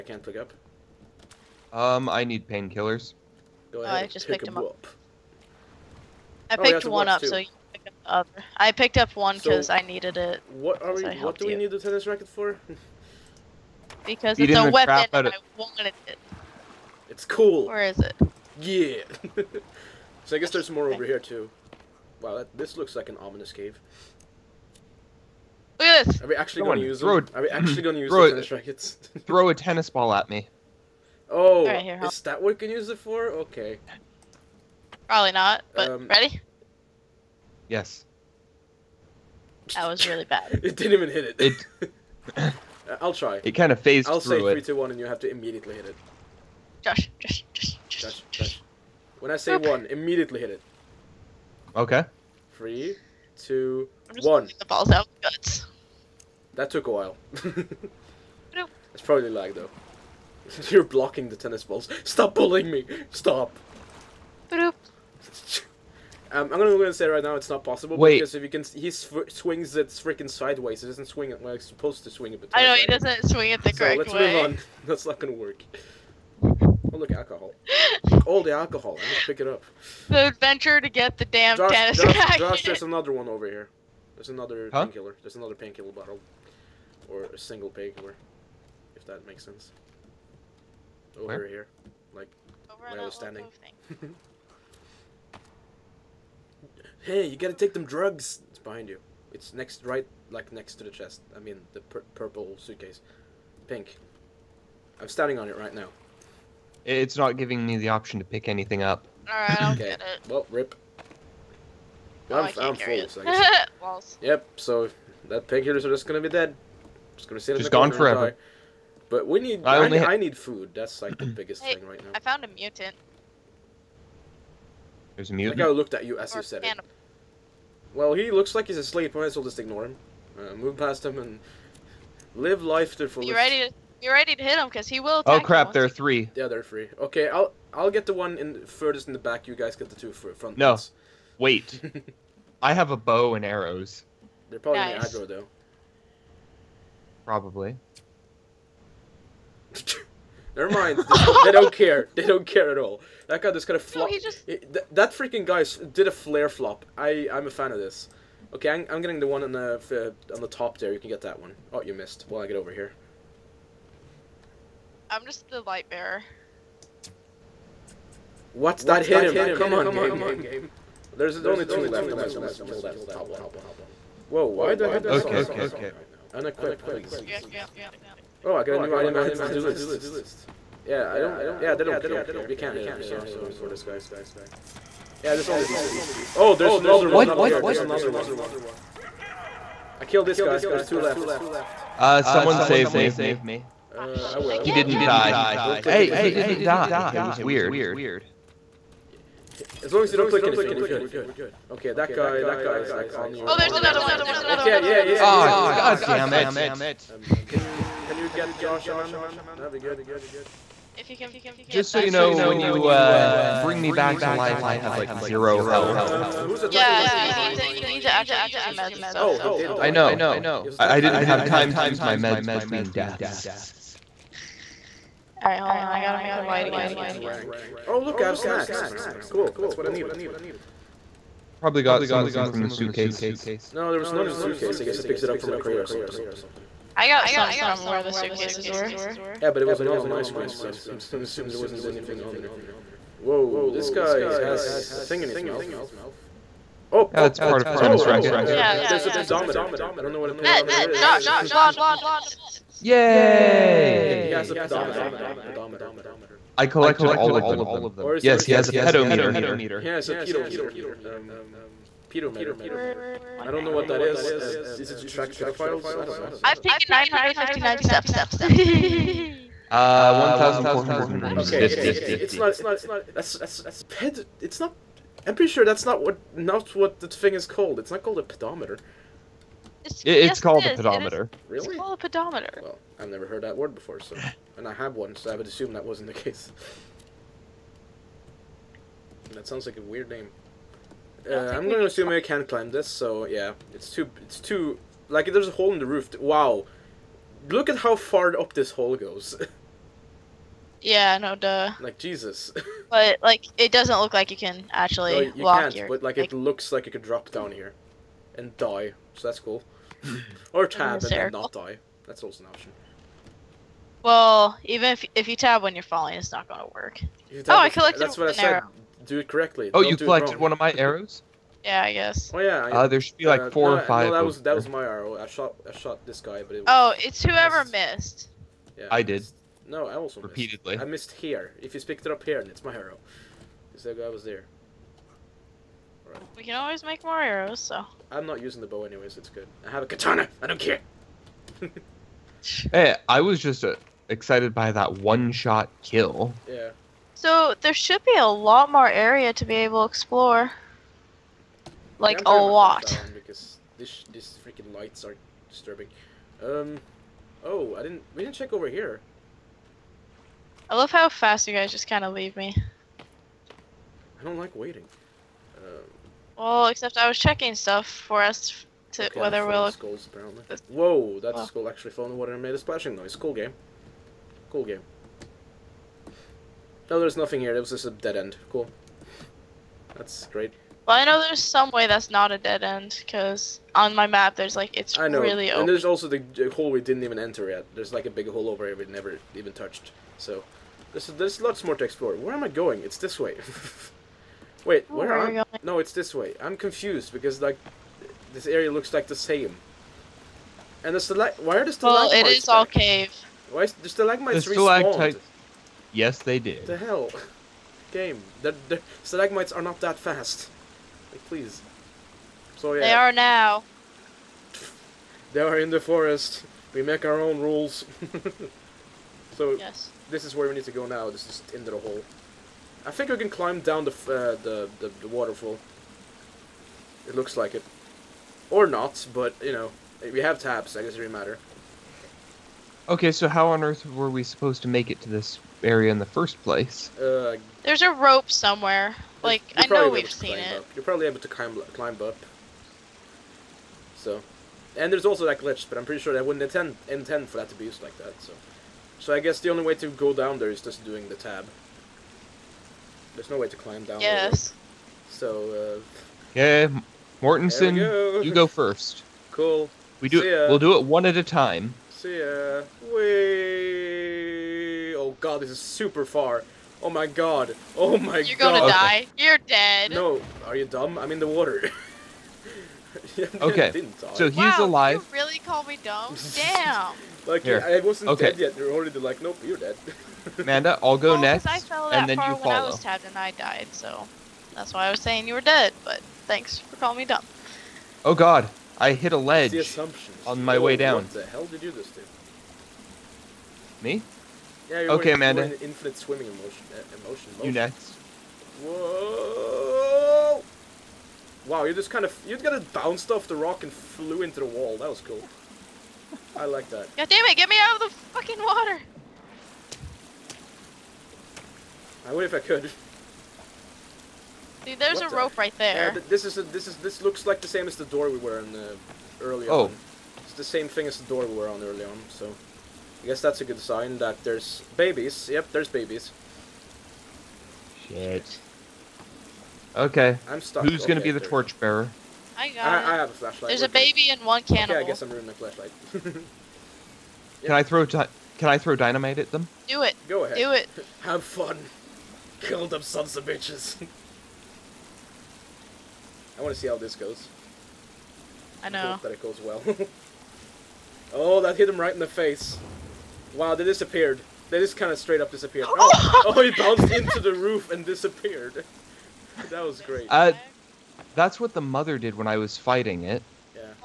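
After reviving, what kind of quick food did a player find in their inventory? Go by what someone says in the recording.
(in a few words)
Snacks.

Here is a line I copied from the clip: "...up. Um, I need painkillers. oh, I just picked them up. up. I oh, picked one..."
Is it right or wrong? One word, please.
right.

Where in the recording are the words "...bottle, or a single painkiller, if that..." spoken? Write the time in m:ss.
1:25.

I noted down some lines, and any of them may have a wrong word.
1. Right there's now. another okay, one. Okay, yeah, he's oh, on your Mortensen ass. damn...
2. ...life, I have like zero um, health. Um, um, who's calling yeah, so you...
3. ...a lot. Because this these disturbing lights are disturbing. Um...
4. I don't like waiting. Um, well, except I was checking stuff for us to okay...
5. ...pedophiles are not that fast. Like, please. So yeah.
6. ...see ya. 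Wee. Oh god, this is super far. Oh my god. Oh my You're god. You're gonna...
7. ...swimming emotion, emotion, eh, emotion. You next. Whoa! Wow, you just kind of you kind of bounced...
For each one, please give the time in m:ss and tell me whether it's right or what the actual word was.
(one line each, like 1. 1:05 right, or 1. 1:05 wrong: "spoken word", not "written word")
1. 3:24 wrong: "God", not "Mortensen"
2. 3:34 wrong: "attacking", not "calling"
3. 5:52 wrong: "freaking", not "disturbing"
4. 6:02 right
5. 6:49 wrong: "stalagmites", not "pedophiles"
6. 7:42 right
7. 8:15 right.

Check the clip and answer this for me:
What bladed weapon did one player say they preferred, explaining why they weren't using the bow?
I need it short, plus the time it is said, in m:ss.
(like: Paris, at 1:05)
Katana, at 5:39.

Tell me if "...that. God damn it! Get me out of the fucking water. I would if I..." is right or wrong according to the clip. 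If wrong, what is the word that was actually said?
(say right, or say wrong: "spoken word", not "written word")
right.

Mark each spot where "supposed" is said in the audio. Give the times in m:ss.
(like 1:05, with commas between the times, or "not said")
1:11, 7:14.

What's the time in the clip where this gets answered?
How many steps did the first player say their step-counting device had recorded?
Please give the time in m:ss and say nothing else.
4:26.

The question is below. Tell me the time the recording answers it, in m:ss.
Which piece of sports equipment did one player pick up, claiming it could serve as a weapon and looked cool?
0:11.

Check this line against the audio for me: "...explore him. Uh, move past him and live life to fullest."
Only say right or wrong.
wrong.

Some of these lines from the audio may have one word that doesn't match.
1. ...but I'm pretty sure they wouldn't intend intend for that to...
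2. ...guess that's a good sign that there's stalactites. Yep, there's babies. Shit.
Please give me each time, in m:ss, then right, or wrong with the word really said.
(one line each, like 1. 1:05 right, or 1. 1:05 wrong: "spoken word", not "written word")
1. 7:25 right
2. 8:43 wrong: "babies", not "stalactites".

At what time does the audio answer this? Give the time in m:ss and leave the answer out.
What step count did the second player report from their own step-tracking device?
4:30.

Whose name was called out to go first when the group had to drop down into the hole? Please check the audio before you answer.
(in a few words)
Mortensen.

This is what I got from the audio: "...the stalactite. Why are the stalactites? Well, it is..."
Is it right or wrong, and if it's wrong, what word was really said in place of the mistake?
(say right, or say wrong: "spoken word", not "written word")
right.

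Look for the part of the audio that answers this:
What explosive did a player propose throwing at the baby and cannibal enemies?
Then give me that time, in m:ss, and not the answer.
8:58.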